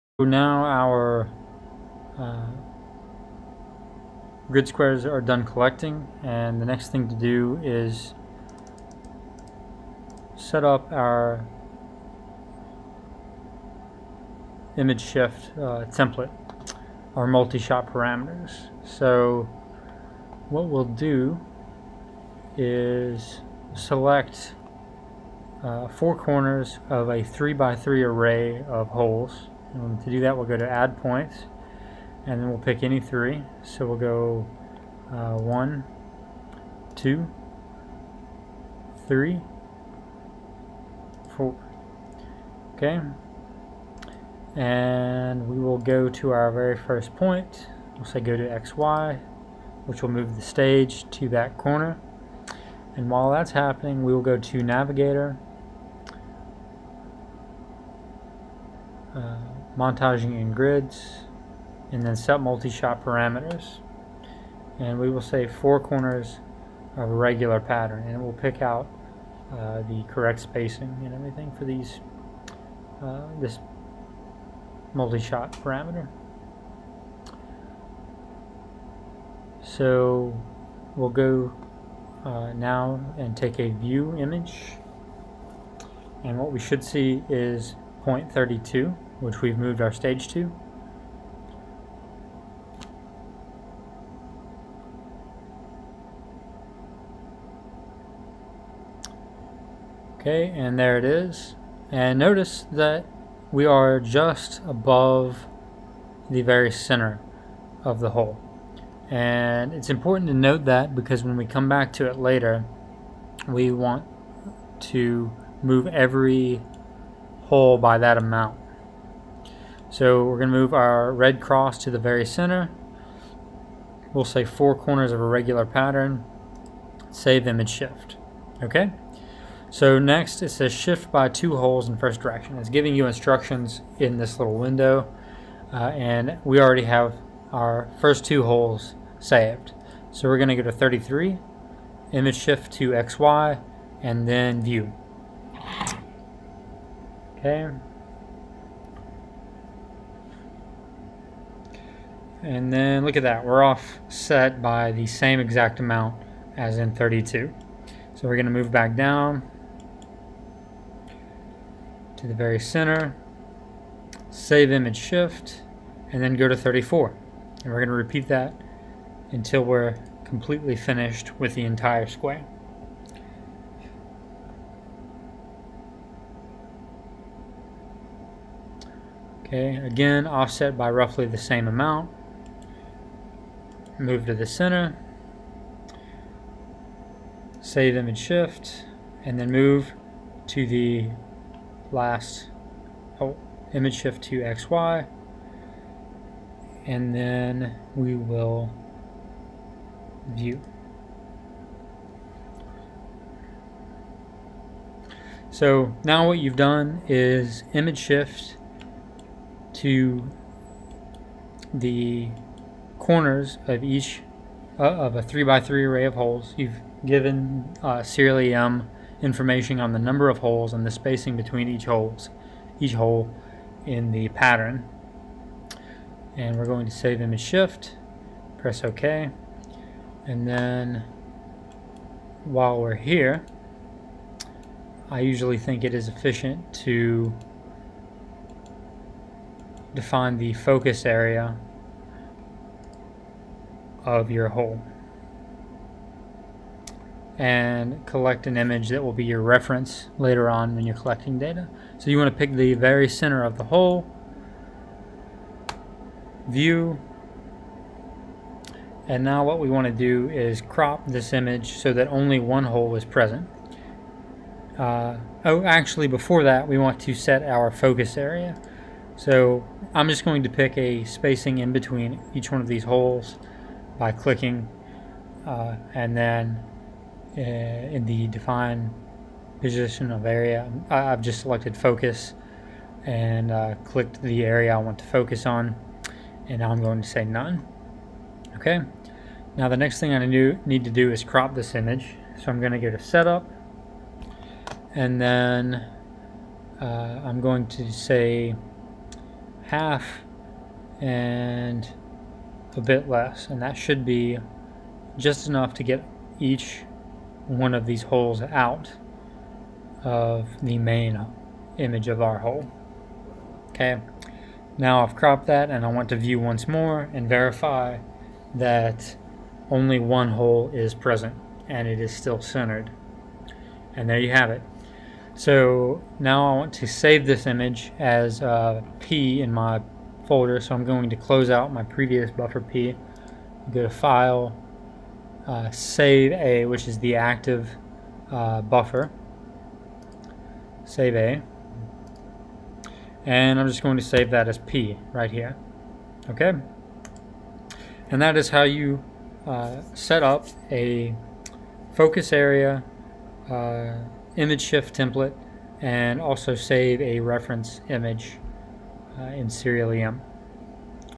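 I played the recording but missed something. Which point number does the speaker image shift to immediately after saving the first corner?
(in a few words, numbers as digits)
33.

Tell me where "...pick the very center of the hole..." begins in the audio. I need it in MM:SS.
04:12.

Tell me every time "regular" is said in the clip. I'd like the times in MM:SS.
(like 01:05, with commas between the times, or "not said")
01:07, 02:05.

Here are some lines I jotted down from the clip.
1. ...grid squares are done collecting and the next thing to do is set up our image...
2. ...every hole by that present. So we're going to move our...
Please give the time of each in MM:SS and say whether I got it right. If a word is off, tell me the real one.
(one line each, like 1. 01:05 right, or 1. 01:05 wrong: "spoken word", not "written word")
1. 00:04 right
2. 01:55 wrong: "amount", not "present".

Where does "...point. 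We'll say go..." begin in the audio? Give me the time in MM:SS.
00:47.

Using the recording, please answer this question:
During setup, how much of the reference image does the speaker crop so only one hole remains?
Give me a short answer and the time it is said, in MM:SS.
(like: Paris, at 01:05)
half and a bit less, at 04:59.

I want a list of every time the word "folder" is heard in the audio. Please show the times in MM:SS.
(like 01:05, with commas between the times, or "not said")
05:30.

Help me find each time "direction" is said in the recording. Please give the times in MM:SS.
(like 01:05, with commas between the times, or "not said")
02:12.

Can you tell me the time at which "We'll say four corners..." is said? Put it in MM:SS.
02:04.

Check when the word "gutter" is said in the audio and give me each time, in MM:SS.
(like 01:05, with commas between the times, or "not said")
not said.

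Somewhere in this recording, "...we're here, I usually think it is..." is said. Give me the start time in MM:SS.
03:52.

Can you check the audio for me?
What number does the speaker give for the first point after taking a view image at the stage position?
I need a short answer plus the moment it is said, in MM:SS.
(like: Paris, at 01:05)
0.32, at 01:28.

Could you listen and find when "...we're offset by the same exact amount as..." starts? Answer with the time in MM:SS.
02:33.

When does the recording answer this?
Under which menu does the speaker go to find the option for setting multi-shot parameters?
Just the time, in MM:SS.
00:54.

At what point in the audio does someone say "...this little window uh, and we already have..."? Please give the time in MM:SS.
02:14.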